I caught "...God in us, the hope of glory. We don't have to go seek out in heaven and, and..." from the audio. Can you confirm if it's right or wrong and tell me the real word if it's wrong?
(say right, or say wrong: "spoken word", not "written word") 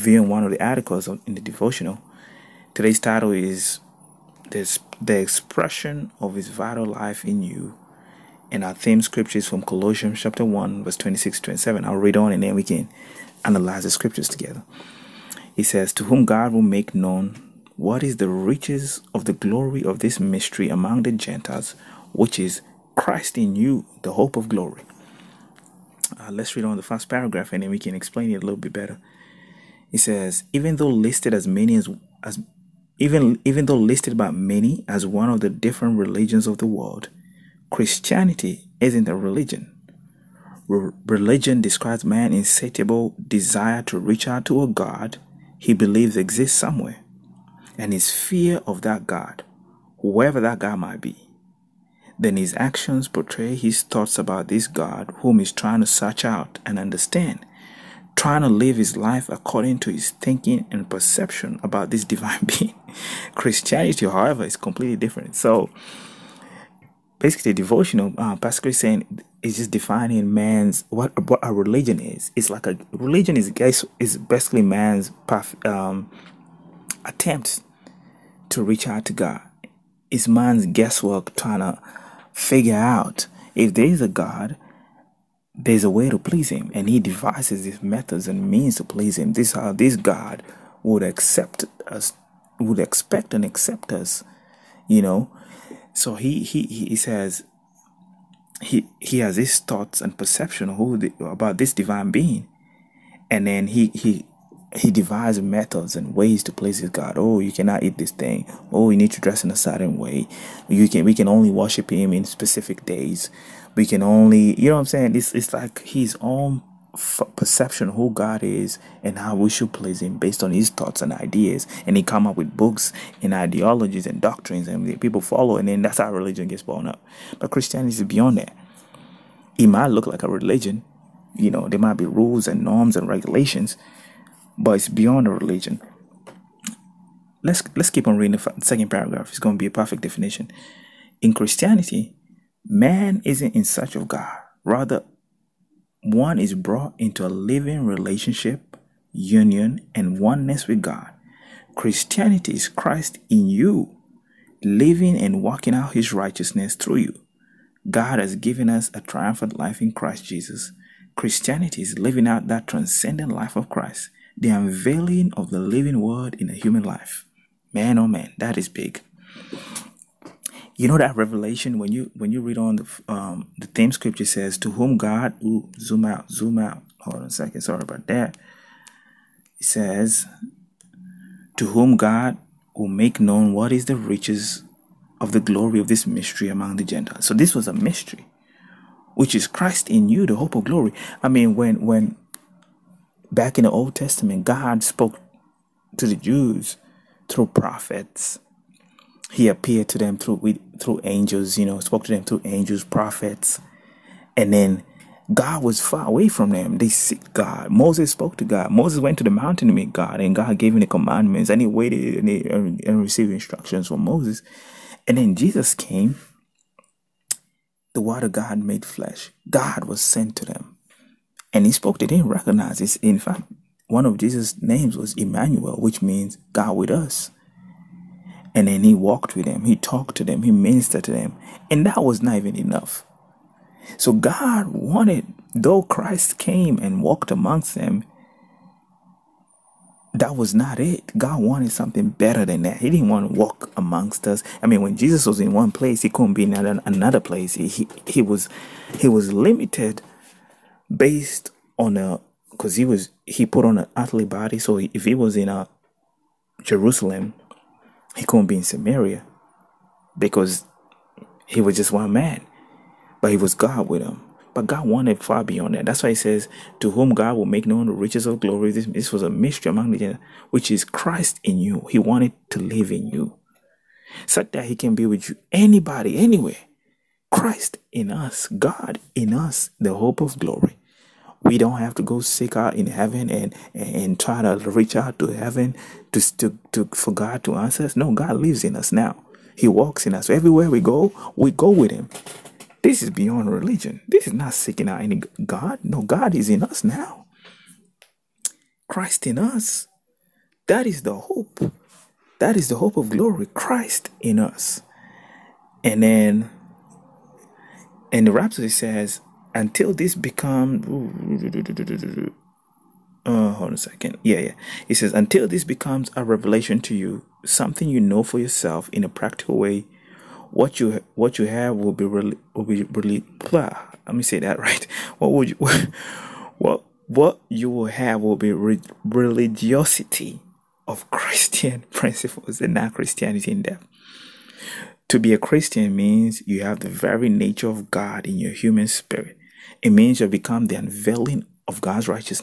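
right.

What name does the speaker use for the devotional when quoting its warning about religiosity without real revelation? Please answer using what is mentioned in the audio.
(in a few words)
Rhapsody.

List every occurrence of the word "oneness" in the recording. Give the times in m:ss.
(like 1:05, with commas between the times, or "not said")
2:30.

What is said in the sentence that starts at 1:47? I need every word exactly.
Oh, you cannot eat this thing.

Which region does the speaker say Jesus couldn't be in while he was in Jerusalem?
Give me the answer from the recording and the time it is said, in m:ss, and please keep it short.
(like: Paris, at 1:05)
Samaria, at 4:18.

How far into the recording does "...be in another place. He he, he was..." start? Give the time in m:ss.
4:06.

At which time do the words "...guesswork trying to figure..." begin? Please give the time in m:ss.
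1:20.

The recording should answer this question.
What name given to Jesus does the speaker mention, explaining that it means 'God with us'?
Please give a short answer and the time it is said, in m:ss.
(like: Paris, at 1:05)
Emmanuel, at 3:45.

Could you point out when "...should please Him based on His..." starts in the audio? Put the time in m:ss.
1:59.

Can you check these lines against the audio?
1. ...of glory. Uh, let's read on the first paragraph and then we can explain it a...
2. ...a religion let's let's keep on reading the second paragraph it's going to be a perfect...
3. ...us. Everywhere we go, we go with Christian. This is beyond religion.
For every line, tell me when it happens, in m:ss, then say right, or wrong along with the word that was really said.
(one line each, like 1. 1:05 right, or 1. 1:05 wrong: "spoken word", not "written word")
1. 0:24 right
2. 2:15 right
3. 4:50 wrong: "Him", not "Christian".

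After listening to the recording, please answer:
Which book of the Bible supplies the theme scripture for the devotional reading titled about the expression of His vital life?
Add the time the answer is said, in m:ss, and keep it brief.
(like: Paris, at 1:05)
Colossians, at 0:09.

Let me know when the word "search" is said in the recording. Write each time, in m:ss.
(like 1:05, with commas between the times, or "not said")
0:55, 2:23.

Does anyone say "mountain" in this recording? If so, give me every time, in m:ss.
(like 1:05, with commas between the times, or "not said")
3:29.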